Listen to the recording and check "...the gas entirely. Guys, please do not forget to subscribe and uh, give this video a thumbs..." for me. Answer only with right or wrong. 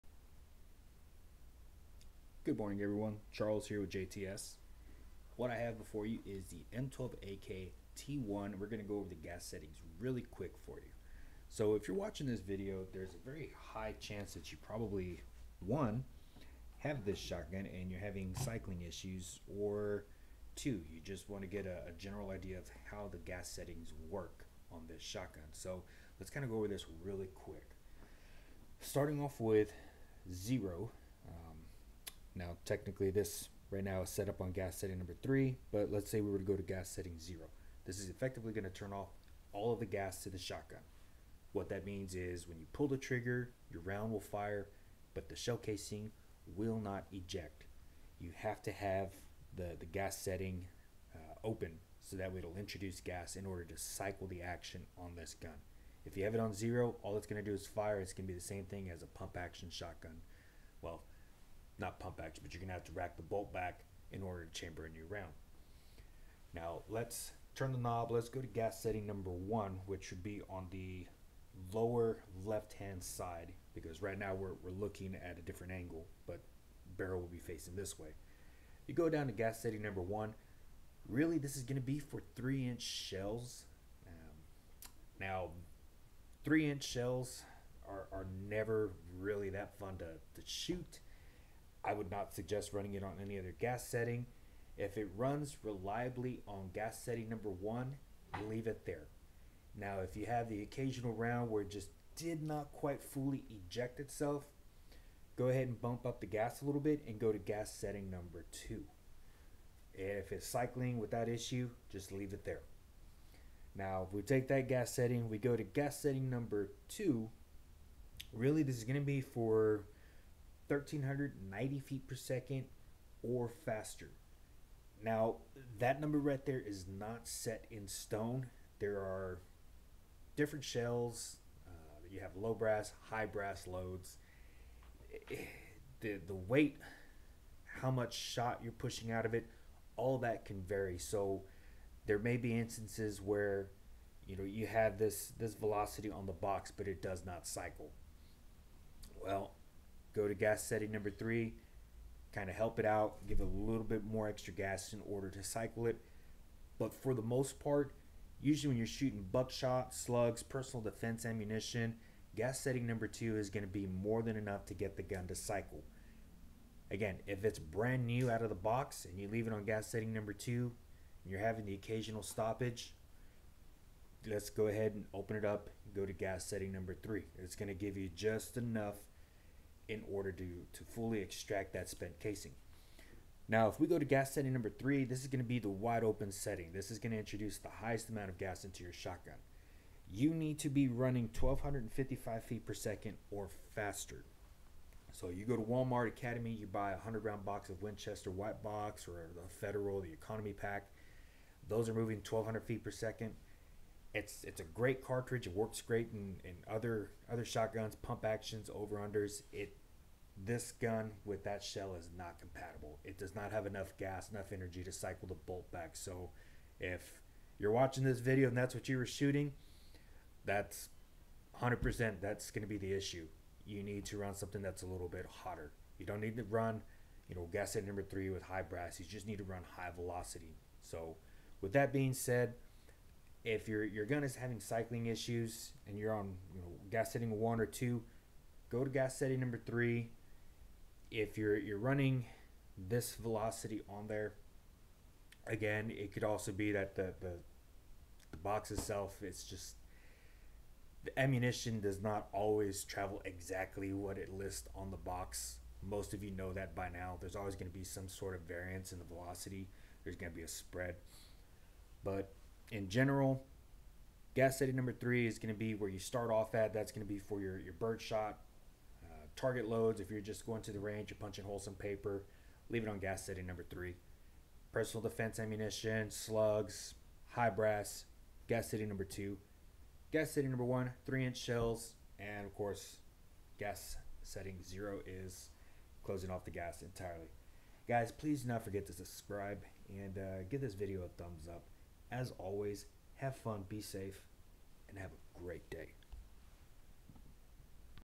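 right.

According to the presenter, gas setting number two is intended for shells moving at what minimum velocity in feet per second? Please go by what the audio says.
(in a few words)
1,390.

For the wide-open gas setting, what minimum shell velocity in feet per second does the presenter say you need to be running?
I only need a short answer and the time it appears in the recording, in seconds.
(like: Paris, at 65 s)
1,255, at 191 s.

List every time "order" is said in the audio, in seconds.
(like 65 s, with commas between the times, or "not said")
53 s, 64 s, 155 s, 180 s.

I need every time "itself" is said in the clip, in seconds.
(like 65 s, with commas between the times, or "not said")
103 s, 248 s.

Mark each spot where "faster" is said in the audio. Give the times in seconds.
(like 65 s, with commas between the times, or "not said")
123 s, 193 s.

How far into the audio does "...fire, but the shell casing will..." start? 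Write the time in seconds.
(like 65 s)
44 s.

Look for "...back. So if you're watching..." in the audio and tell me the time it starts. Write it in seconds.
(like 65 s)
215 s.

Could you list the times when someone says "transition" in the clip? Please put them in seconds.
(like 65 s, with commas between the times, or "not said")
not said.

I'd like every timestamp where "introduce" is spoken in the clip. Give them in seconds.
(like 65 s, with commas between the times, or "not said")
52 s, 187 s.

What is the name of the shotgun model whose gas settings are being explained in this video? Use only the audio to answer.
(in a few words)
M12AK T1.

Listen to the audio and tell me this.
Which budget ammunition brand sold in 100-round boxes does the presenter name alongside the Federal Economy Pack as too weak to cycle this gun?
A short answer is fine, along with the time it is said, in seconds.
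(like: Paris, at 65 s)
Winchester White Box, at 197 s.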